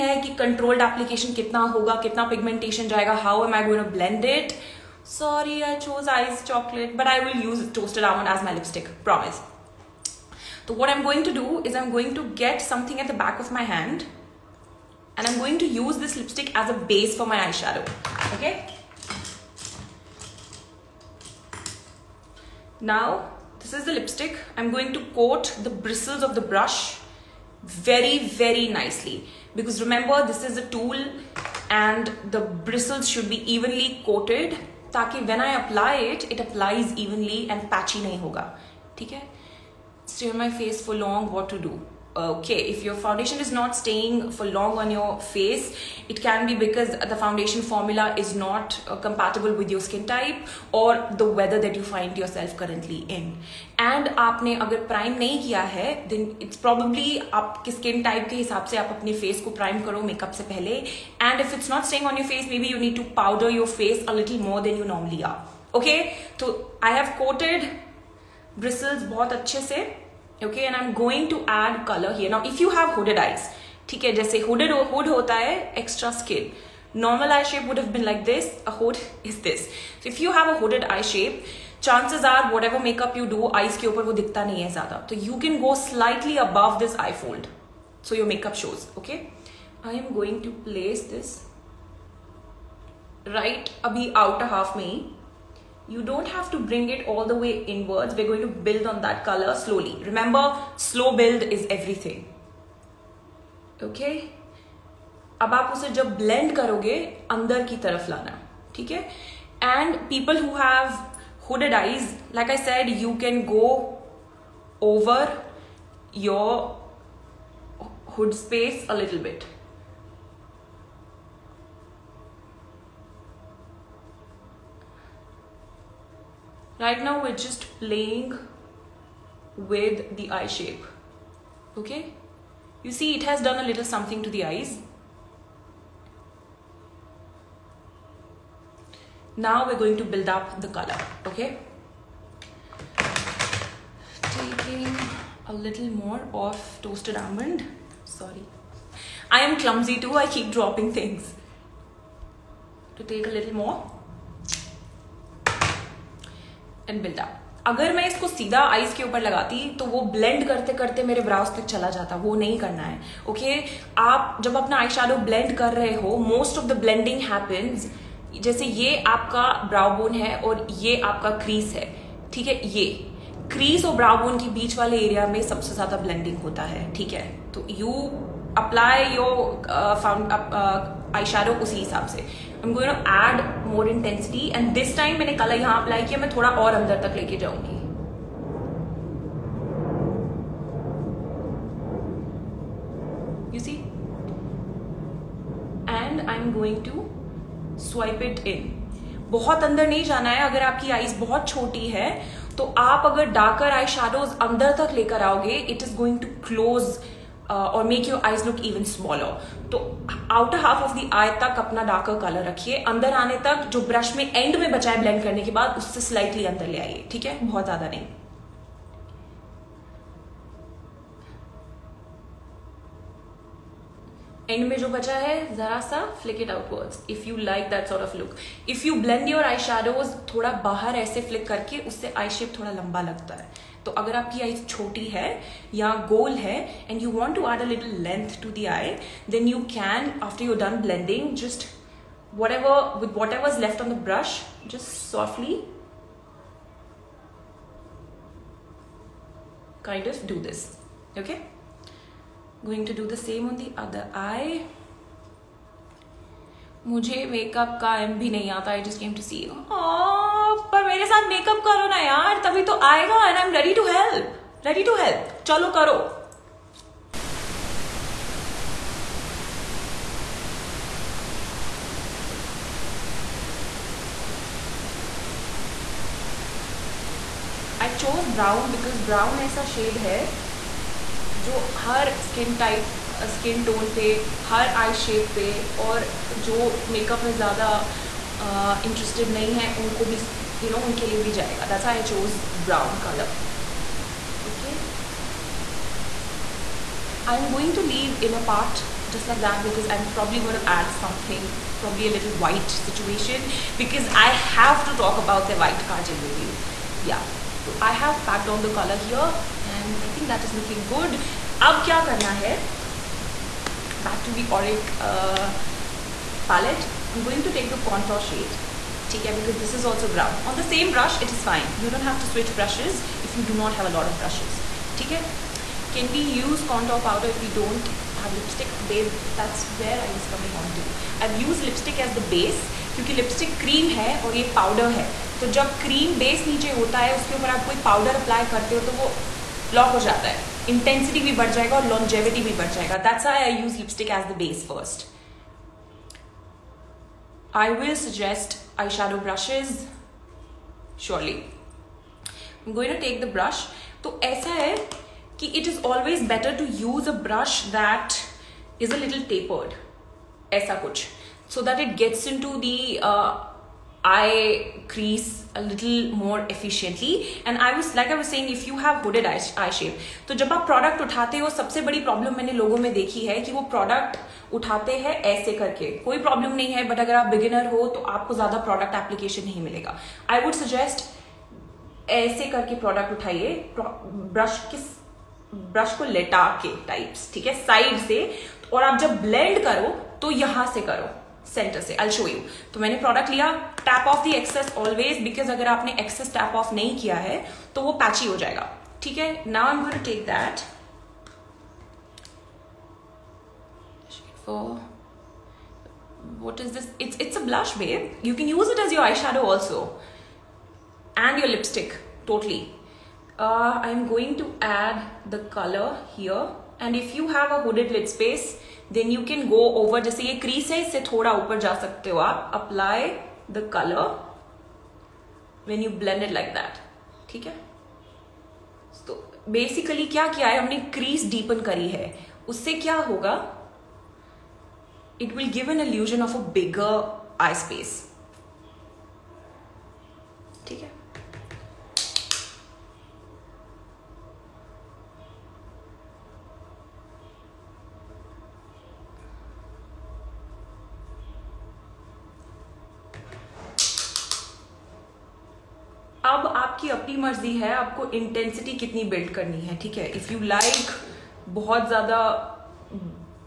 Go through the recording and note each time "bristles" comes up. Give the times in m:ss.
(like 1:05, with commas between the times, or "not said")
0:25, 0:32.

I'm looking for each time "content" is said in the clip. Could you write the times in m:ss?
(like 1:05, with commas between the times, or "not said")
not said.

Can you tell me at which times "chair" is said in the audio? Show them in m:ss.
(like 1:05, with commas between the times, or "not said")
not said.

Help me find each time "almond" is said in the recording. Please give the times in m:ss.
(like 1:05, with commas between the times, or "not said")
0:08, 2:27.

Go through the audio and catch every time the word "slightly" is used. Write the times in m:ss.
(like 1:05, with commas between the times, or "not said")
1:25.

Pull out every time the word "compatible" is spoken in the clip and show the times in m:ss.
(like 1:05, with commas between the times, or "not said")
0:48.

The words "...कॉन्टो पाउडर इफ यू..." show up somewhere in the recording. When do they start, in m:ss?
5:26.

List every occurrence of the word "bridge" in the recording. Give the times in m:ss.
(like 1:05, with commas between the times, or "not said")
not said.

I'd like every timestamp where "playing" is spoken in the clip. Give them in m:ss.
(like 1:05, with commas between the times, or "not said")
2:07.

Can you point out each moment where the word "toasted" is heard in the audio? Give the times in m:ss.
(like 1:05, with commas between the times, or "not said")
0:07, 2:26.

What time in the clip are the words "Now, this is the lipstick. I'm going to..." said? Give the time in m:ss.
0:22.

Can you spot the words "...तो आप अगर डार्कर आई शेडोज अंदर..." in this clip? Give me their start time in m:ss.
3:22.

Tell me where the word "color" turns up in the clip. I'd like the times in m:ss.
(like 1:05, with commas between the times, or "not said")
1:11, 1:39, 2:20.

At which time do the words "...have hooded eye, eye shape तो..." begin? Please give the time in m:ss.
6:08.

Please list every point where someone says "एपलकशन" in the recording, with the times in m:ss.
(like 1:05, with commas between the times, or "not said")
0:00, 6:19.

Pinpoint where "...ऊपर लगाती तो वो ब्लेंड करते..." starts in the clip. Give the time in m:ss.
2:39.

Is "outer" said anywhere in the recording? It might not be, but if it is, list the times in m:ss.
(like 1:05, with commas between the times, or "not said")
1:34.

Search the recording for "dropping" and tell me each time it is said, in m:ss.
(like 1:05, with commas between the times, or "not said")
2:30.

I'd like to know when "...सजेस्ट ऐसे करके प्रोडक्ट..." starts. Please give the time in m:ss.
6:20.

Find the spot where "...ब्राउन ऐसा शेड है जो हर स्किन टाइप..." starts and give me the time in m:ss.
4:39.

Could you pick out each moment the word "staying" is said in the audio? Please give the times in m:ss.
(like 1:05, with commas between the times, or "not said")
0:43.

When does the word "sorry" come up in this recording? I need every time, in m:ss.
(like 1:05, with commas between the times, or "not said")
0:05, 2:28.